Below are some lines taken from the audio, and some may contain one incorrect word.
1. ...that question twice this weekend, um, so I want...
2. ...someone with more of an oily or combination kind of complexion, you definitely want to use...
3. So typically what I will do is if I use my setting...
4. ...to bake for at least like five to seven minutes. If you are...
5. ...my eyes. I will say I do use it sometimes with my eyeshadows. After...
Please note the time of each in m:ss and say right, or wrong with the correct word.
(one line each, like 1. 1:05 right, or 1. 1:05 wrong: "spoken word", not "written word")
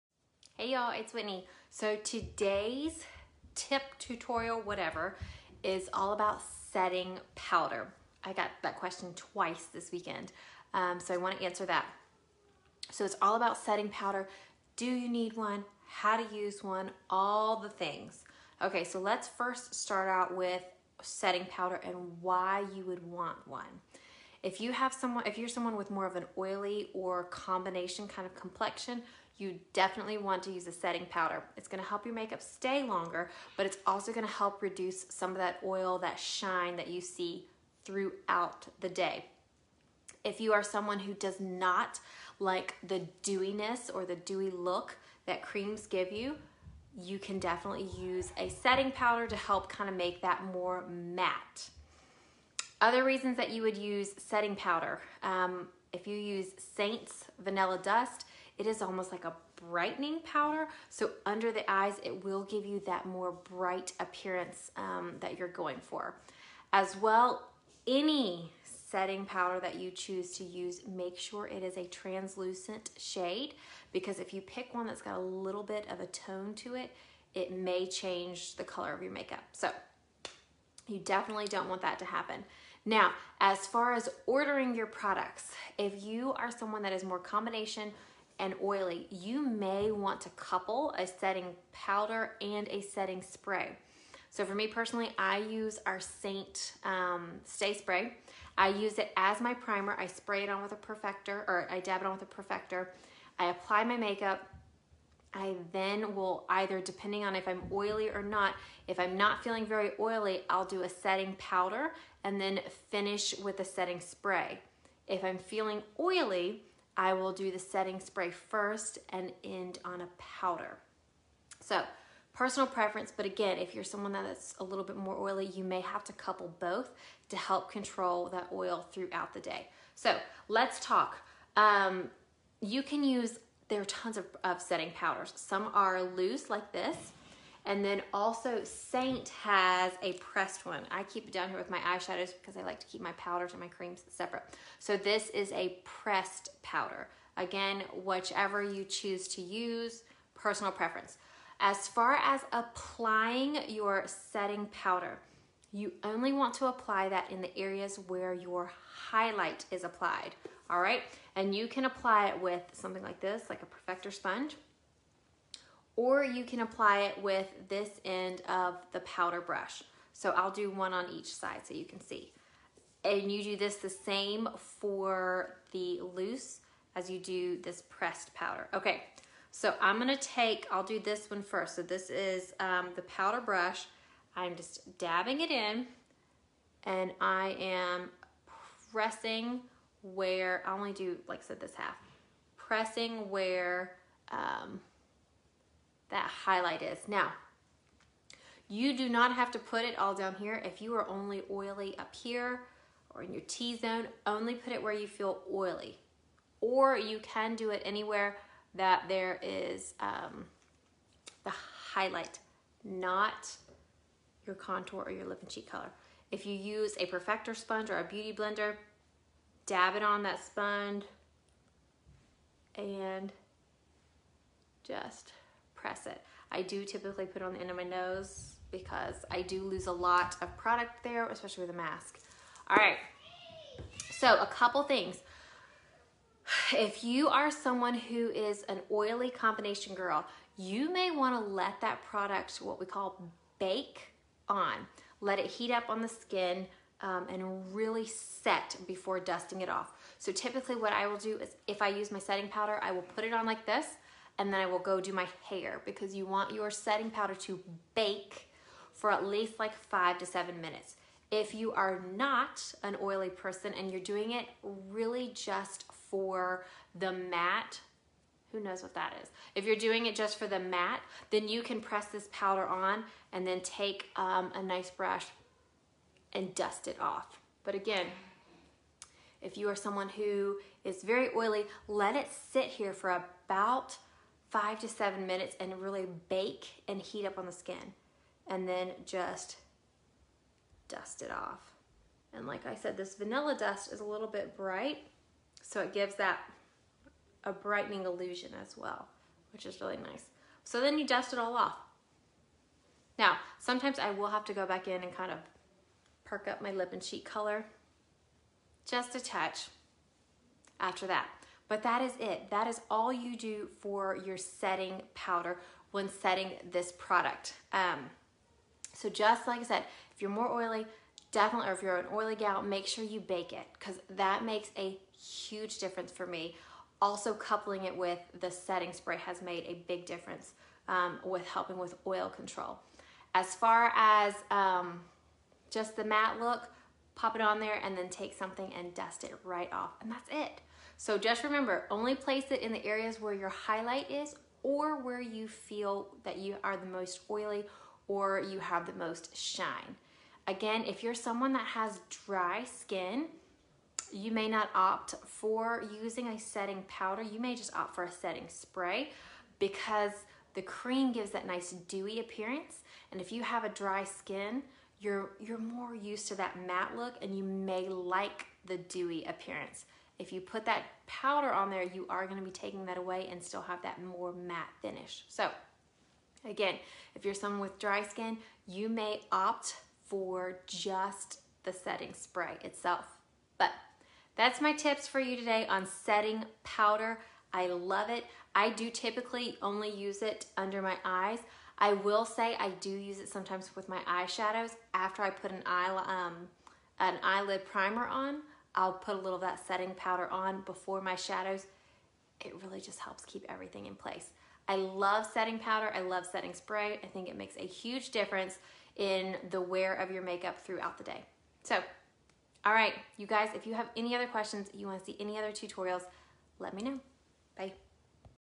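1. 0:08 right
2. 0:25 right
3. 4:10 right
4. 4:17 right
5. 6:30 right.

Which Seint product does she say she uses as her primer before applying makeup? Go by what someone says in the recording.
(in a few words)
Stay Spray.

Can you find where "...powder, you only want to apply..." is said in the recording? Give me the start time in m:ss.
2:34.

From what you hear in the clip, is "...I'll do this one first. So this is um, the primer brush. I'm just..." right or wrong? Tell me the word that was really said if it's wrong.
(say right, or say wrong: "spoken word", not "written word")
wrong: "powder", not "primer".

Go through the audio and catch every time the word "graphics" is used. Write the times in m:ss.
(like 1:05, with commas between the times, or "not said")
not said.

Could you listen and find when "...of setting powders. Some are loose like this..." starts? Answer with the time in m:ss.
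2:14.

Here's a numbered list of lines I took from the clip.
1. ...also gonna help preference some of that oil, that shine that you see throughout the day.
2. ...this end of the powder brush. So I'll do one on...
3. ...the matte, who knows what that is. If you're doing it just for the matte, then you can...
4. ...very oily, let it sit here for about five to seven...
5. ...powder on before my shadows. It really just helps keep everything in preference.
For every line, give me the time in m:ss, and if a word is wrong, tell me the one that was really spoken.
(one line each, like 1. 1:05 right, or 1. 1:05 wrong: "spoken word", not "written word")
1. 0:33 wrong: "reduce", not "preference"
2. 2:47 right
3. 4:26 right
4. 4:41 right
5. 6:39 wrong: "place", not "preference".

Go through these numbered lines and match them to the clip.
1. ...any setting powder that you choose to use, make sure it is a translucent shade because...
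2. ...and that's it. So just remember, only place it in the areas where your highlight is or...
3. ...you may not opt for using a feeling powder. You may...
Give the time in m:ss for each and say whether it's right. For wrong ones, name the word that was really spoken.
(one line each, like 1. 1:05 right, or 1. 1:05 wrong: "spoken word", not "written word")
1. 1:07 right
2. 5:40 right
3. 5:54 wrong: "setting", not "feeling".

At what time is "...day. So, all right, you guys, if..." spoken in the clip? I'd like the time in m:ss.
6:51.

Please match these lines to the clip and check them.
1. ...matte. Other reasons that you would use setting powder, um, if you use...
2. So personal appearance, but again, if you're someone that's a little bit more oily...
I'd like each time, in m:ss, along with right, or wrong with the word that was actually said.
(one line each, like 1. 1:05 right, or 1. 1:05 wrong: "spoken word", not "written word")
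1. 0:50 right
2. 2:01 wrong: "preference", not "appearance".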